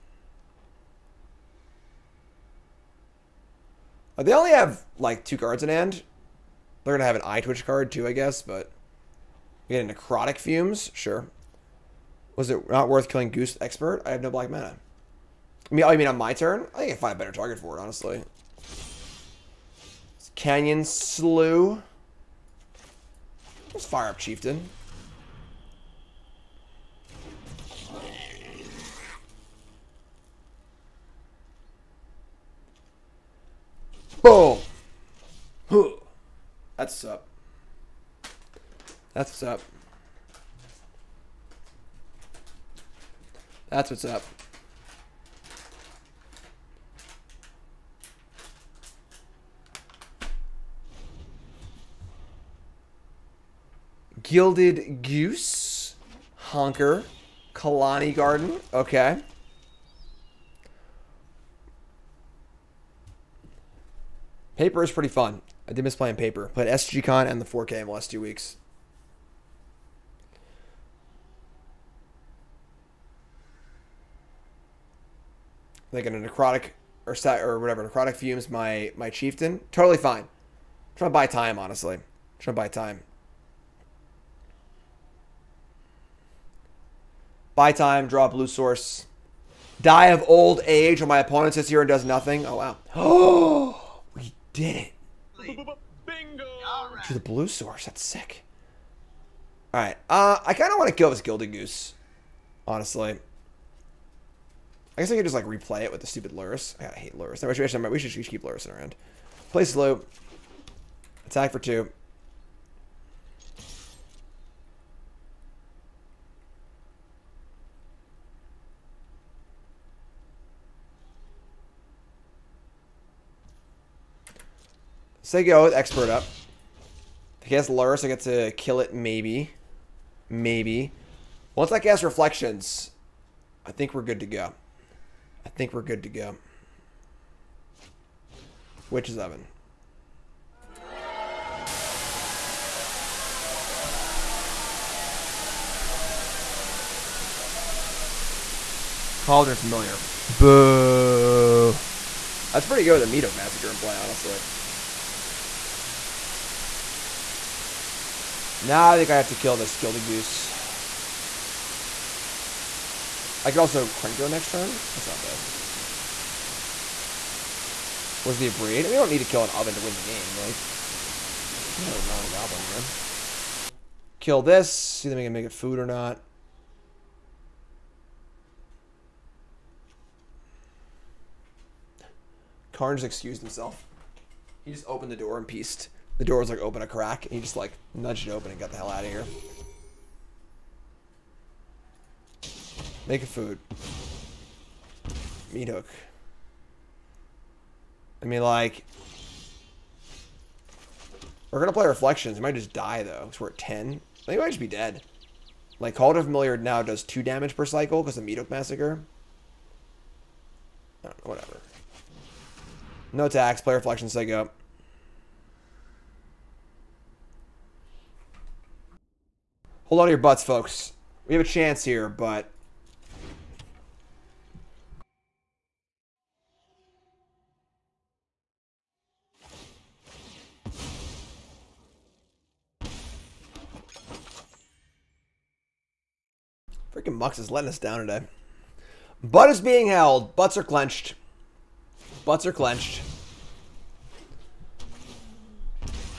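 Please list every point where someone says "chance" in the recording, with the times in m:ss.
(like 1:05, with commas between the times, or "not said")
3:41.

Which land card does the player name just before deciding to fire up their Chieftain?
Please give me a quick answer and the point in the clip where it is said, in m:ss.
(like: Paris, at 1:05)
Canyon Slough, at 0:20.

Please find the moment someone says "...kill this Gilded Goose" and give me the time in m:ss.
2:39.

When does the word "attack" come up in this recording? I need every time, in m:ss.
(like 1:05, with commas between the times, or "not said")
1:51, 3:33.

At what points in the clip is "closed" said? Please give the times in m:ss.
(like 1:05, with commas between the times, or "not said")
not said.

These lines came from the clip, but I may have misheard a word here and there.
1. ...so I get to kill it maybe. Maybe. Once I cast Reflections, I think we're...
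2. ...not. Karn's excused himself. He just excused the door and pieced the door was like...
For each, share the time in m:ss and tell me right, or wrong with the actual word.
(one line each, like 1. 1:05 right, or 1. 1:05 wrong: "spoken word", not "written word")
1. 2:07 right
2. 2:55 wrong: "opened", not "excused".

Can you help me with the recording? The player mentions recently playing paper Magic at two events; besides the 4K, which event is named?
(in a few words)
SGCon.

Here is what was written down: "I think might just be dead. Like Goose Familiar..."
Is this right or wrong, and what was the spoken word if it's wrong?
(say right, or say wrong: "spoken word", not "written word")
wrong: "Cauldron", not "Goose".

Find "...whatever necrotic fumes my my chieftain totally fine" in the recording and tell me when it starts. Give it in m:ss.
1:17.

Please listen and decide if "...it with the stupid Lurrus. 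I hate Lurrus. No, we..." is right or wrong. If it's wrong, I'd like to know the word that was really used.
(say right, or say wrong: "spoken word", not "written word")
right.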